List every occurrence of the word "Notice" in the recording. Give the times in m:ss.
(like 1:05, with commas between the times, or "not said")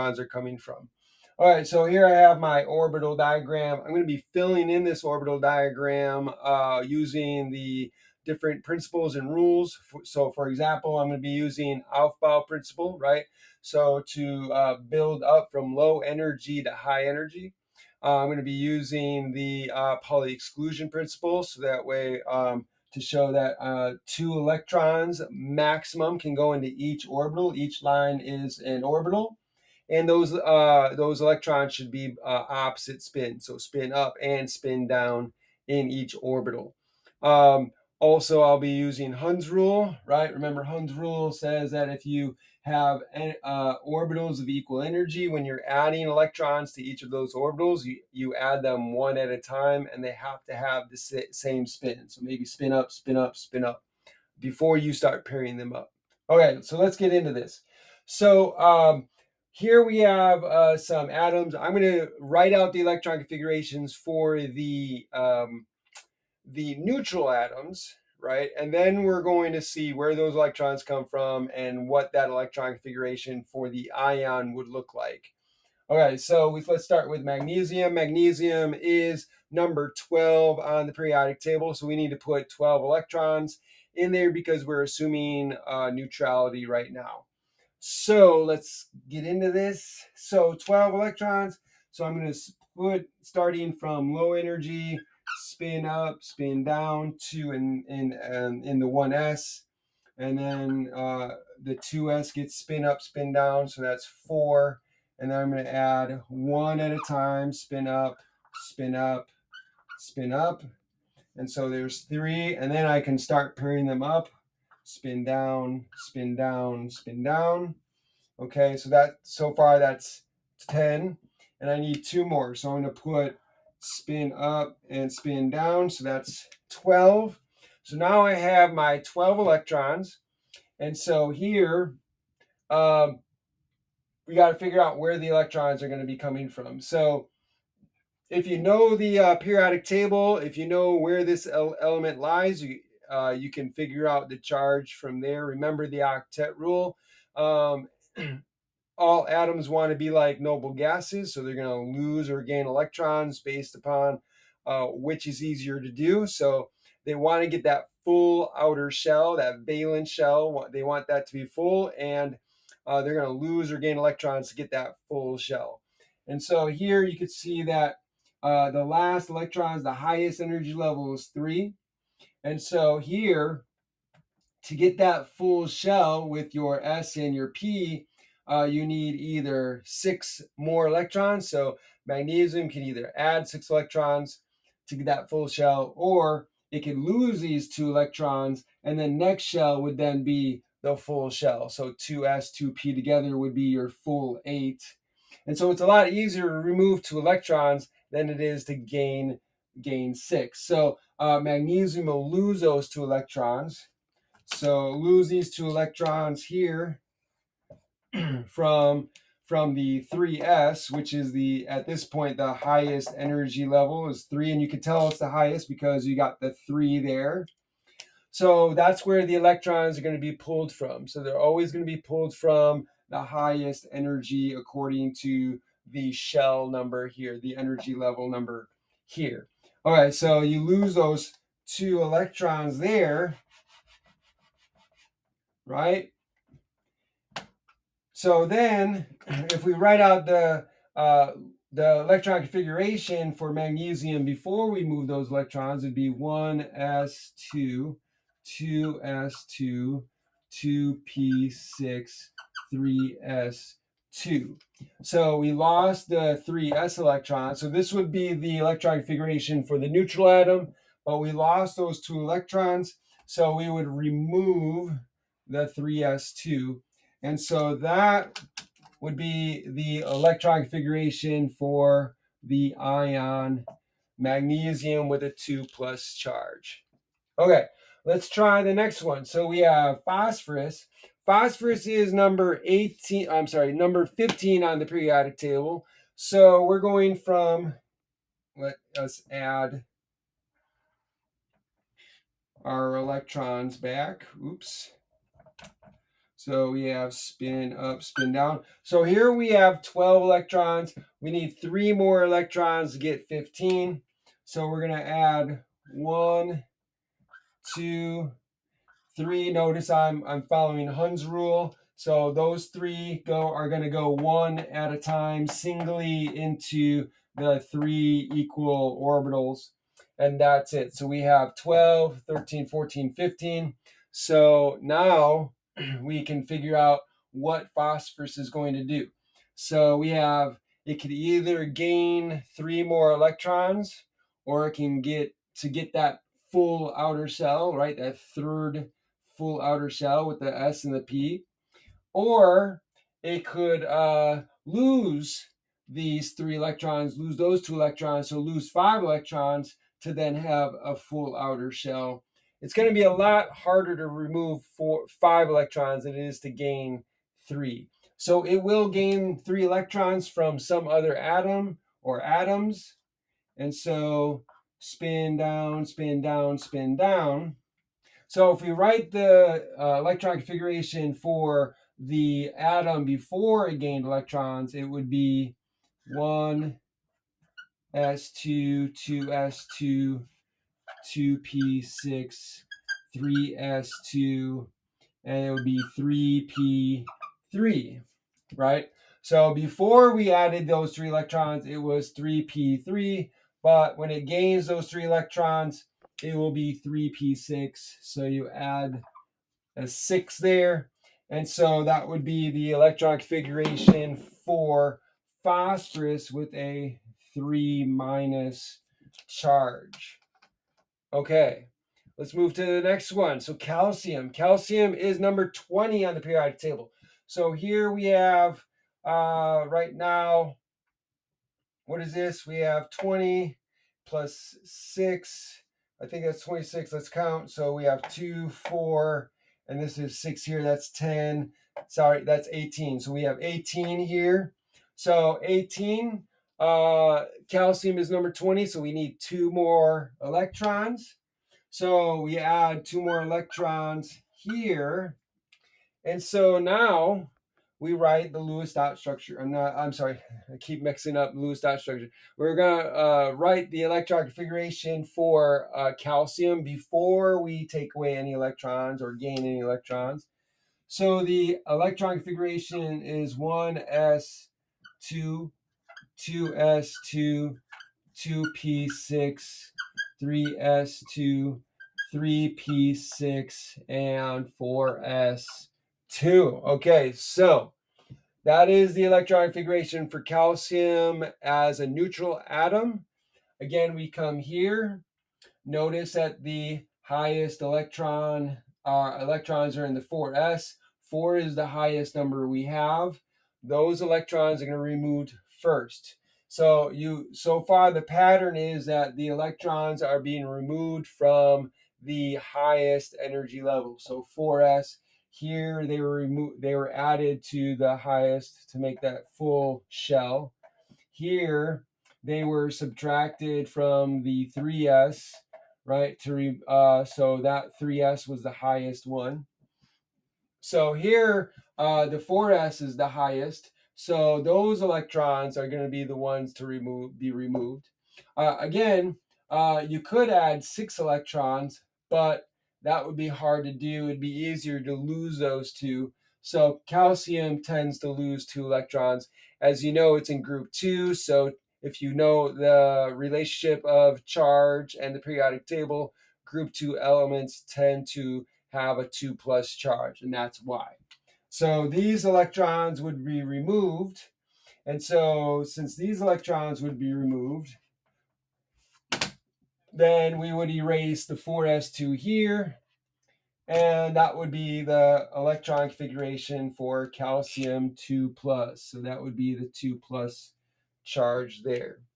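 5:09, 8:05.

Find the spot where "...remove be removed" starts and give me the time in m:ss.
8:46.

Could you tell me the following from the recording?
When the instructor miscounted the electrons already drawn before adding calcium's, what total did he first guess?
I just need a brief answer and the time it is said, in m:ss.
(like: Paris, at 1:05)
26, at 7:06.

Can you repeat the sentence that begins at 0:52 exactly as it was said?
So maybe spin up, spin up, spin up before you start pairing them up.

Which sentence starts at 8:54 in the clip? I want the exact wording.
It'd be easier to lose those two.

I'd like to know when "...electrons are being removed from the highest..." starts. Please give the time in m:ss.
8:19.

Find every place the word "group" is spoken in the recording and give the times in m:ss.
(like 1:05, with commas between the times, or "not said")
9:00, 9:06.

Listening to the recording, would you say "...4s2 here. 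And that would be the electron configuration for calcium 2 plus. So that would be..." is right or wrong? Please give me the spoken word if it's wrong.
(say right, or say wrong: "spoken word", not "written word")
right.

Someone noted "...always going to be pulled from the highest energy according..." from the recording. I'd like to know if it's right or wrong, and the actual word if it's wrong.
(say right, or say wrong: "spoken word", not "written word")
right.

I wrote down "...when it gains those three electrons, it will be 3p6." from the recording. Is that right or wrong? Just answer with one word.
right.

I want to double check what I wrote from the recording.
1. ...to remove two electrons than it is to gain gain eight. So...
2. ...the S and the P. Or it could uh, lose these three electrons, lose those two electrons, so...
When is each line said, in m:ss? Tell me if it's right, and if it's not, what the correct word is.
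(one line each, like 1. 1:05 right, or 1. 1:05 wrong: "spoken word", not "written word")
1. 3:16 wrong: "six", not "eight"
2. 5:40 right.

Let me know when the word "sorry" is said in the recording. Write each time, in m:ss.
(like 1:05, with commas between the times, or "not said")
4:43, 7:11, 7:29.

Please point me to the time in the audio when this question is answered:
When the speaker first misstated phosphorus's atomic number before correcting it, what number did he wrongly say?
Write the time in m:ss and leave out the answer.
4:42.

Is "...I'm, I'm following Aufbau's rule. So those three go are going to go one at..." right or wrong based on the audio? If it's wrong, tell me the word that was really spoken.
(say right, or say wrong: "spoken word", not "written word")
wrong: "Hund", not "Aufbau".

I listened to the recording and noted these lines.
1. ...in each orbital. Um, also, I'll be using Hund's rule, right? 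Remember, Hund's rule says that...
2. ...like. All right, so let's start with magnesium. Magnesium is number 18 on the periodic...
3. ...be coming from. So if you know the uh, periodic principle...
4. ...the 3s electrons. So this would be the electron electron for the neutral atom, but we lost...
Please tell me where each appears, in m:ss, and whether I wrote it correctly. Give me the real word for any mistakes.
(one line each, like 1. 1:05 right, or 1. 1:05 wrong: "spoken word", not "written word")
1. 0:35 right
2. 1:14 wrong: "12", not "18"
3. 2:16 wrong: "table", not "principle"
4. 4:16 wrong: "configuration", not "electron".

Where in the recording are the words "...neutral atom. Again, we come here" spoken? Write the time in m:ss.
8:01.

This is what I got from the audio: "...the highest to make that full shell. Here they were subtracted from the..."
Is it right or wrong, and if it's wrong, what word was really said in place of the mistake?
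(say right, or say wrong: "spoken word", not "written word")
right.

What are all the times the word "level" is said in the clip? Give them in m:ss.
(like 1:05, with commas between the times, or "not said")
2:50, 3:33, 3:47, 8:23.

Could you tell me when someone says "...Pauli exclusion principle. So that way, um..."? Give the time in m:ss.
0:20.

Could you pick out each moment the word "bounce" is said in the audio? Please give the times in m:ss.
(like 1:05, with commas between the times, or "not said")
not said.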